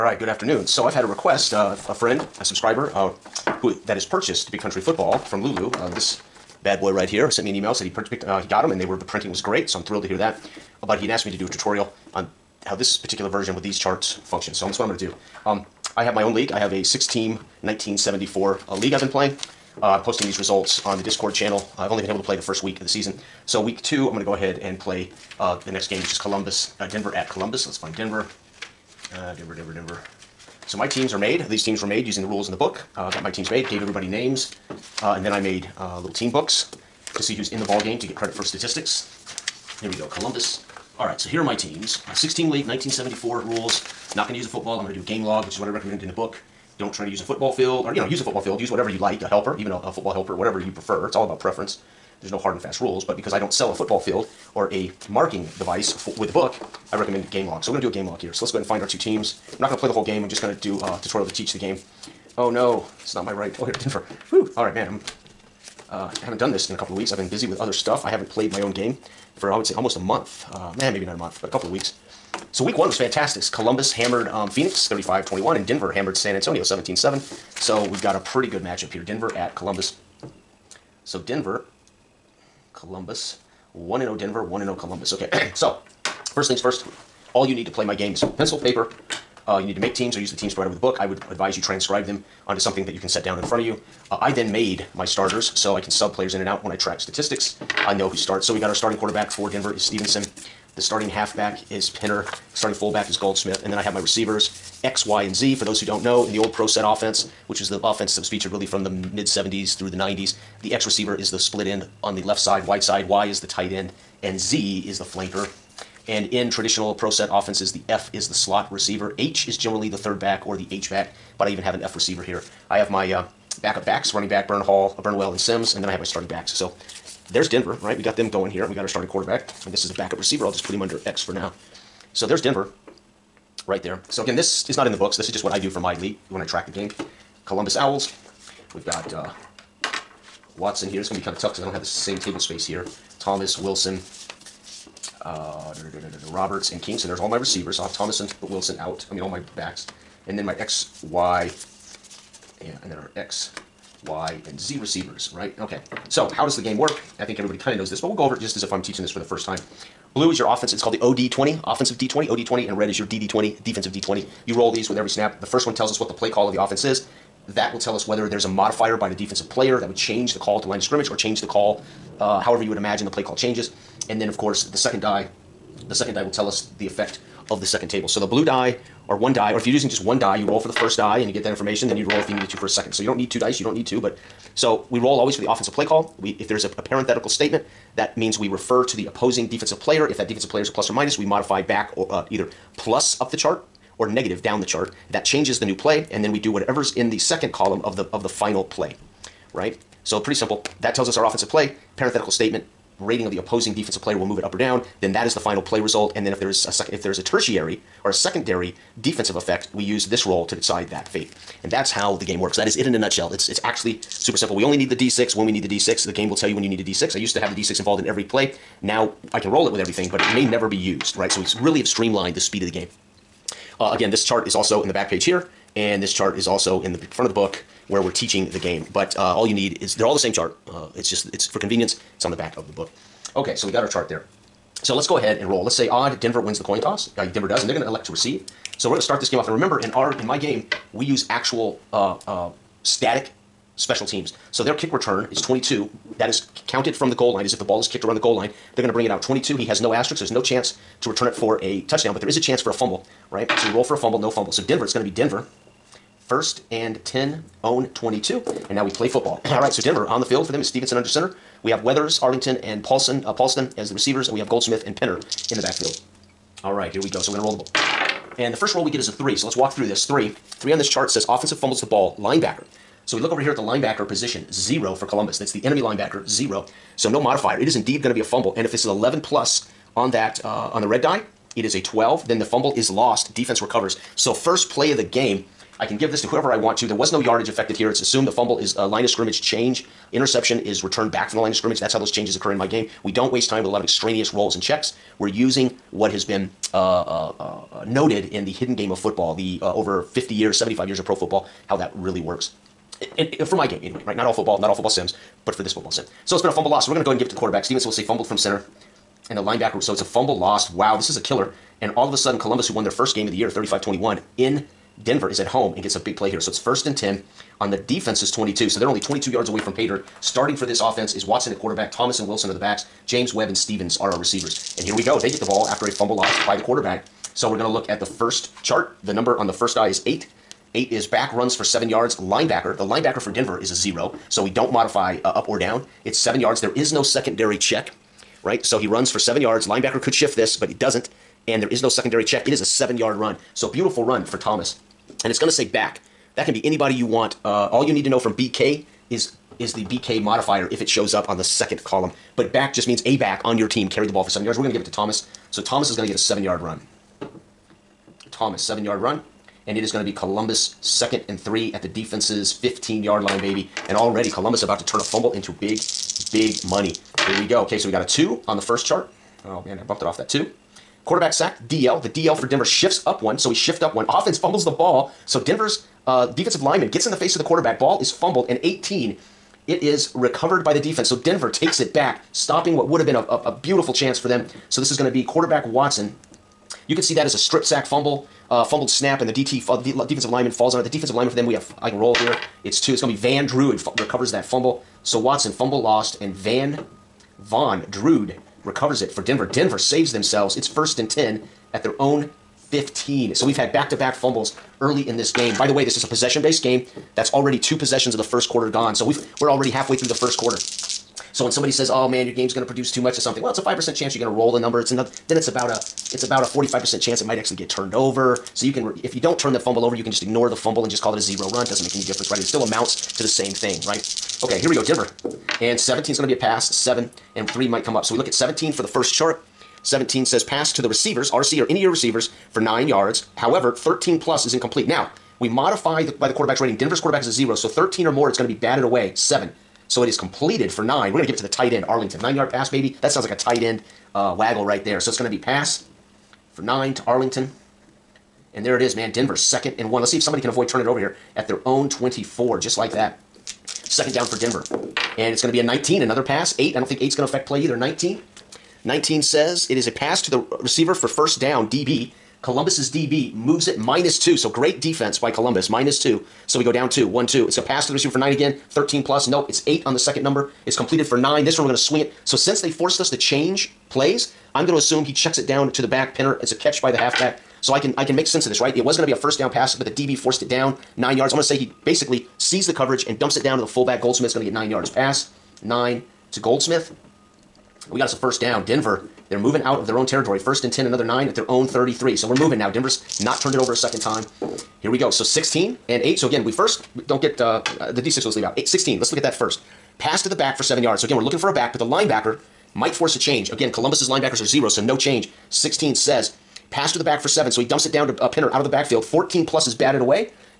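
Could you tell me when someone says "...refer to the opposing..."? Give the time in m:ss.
3:08.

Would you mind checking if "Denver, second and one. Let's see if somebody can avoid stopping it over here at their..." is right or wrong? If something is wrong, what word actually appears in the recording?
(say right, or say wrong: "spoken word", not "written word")
wrong: "turning", not "stopping".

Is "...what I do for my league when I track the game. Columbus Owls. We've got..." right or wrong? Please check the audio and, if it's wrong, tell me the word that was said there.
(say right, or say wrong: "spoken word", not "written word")
right.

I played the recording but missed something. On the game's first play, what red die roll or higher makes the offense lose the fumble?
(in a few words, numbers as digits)
11.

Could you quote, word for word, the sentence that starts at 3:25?
Then that is the final play result.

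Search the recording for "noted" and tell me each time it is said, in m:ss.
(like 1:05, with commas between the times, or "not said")
4:57.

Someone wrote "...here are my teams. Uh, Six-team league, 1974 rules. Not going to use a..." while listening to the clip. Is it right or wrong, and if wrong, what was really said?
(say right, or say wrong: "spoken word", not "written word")
right.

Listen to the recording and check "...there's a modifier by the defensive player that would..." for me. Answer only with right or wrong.
right.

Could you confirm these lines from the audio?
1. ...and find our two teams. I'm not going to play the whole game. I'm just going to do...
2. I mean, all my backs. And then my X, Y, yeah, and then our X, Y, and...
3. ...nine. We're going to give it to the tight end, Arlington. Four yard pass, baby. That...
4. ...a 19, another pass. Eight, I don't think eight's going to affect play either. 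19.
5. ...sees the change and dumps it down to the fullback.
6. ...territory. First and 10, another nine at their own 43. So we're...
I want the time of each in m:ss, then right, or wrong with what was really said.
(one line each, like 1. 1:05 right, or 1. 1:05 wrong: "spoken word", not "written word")
1. 0:58 right
2. 2:29 right
3. 7:20 wrong: "Nine", not "Four"
4. 7:35 right
5. 8:02 wrong: "coverage", not "change"
6. 8:10 wrong: "33", not "43".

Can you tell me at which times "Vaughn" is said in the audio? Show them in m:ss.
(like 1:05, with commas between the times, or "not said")
6:37.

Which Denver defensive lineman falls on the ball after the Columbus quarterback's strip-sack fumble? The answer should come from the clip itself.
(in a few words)
Van Druid.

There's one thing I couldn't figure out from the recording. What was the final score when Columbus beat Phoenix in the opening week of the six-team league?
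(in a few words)
35-21.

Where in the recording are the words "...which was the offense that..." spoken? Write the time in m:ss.
1:47.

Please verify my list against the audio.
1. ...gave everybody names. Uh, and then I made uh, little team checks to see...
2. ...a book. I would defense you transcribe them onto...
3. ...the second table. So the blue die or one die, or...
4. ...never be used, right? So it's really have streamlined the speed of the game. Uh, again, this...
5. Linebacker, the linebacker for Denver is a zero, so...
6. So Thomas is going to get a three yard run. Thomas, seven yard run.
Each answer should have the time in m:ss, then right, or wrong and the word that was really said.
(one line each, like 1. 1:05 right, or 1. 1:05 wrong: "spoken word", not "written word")
1. 0:33 wrong: "books", not "checks"
2. 1:30 wrong: "advise", not "defense"
3. 2:57 right
4. 3:40 right
5. 5:32 right
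6. 5:55 wrong: "seven", not "three".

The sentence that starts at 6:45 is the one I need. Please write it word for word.
By the way, this is a possession based game.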